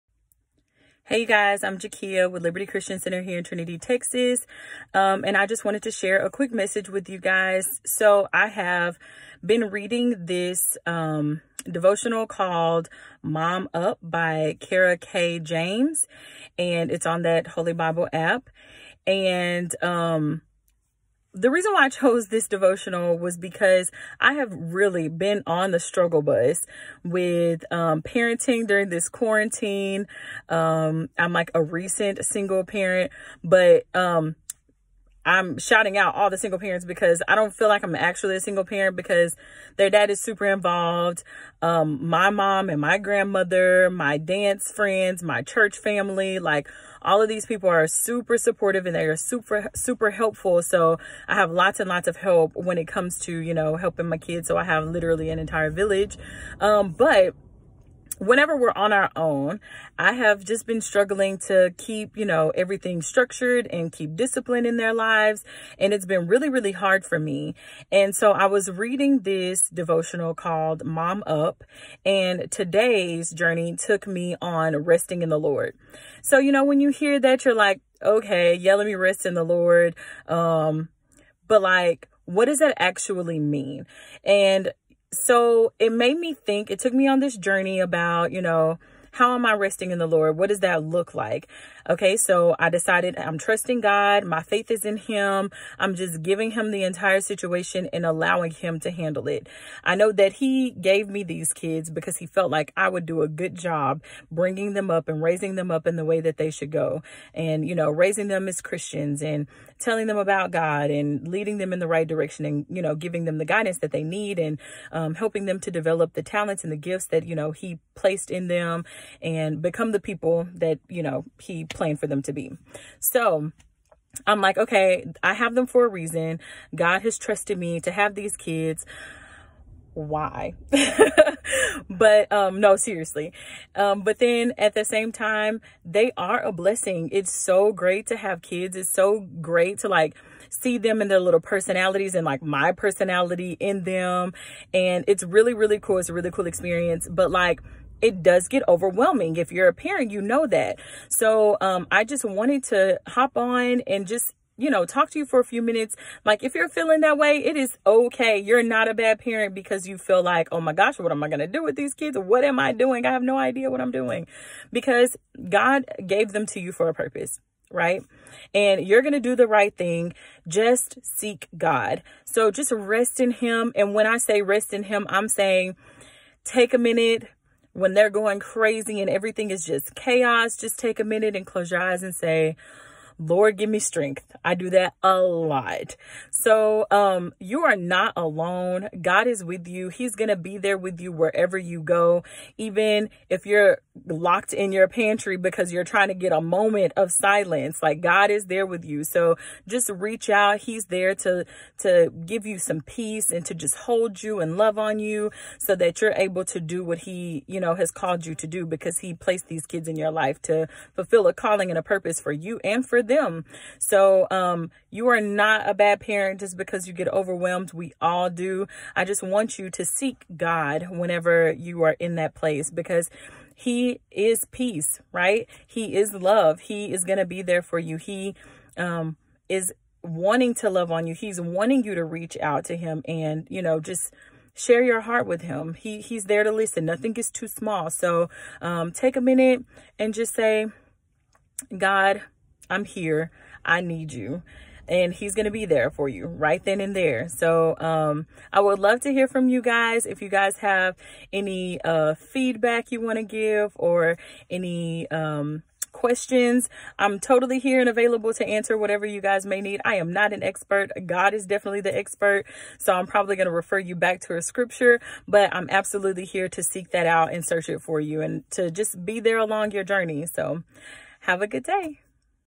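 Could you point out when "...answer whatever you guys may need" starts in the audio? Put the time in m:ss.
4:18.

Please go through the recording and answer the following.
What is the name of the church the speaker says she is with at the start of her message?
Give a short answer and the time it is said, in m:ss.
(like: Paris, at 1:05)
Liberty Christian Center, at 0:02.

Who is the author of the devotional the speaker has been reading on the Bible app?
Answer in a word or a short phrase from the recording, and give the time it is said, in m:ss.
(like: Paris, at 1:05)
Kara K. James, at 0:14.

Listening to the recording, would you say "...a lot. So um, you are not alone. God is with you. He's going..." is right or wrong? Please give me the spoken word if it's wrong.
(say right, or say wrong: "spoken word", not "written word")
right.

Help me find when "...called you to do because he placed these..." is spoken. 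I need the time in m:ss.
3:27.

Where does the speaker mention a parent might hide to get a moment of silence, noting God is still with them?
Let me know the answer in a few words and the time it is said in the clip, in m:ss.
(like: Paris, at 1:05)
pantry, at 3:14.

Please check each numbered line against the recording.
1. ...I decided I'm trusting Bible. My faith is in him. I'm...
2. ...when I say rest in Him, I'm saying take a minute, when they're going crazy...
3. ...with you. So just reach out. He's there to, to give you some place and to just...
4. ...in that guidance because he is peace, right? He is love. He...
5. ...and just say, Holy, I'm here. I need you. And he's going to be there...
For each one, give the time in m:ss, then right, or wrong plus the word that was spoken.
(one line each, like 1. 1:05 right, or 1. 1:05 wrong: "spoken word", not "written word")
1. 1:32 wrong: "God", not "Bible"
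2. 2:53 right
3. 3:18 wrong: "peace", not "place"
4. 3:41 wrong: "place", not "guidance"
5. 3:59 wrong: "God", not "Holy".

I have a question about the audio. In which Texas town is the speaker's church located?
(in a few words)
Trinity.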